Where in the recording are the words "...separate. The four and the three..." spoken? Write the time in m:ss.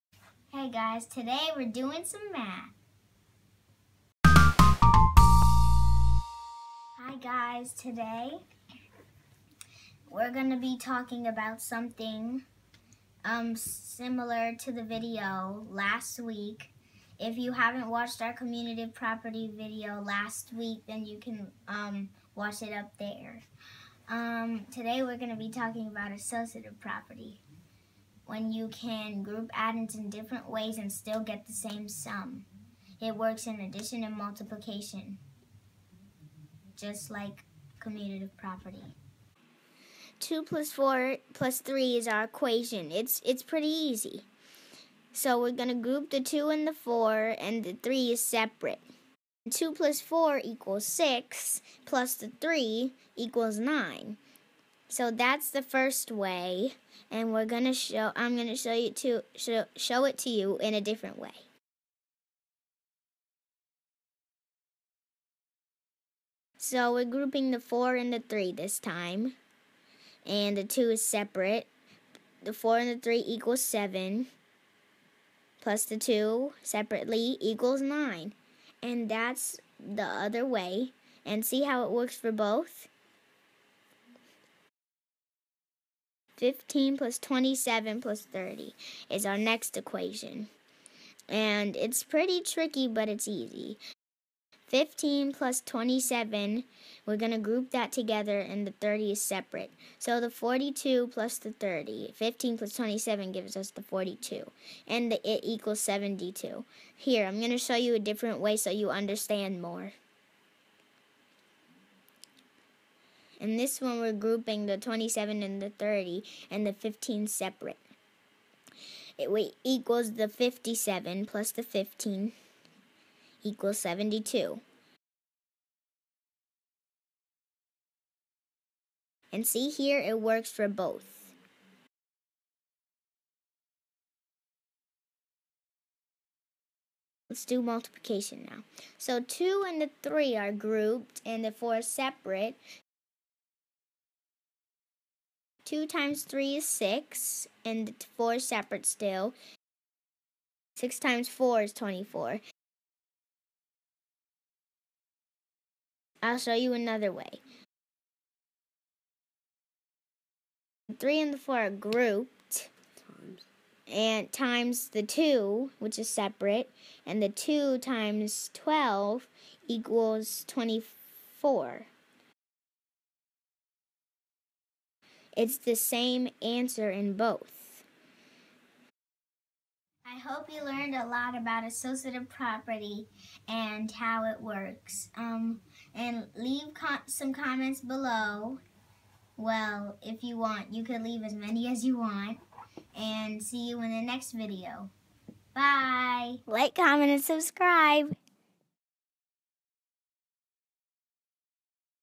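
1:11.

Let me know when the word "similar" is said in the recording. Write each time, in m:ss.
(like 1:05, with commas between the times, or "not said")
0:13.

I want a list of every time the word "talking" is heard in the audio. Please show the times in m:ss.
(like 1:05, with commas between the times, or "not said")
0:10, 0:25.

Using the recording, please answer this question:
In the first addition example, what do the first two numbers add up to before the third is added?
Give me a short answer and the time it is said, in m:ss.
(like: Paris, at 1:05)
6, at 0:49.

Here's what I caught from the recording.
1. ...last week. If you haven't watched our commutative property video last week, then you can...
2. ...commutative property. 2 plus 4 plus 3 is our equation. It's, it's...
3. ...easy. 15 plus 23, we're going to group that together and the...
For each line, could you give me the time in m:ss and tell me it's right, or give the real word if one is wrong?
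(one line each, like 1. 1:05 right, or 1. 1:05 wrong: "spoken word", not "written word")
1. 0:15 right
2. 0:37 right
3. 1:33 wrong: "27", not "23".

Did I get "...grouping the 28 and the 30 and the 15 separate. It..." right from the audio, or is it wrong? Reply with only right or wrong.
wrong.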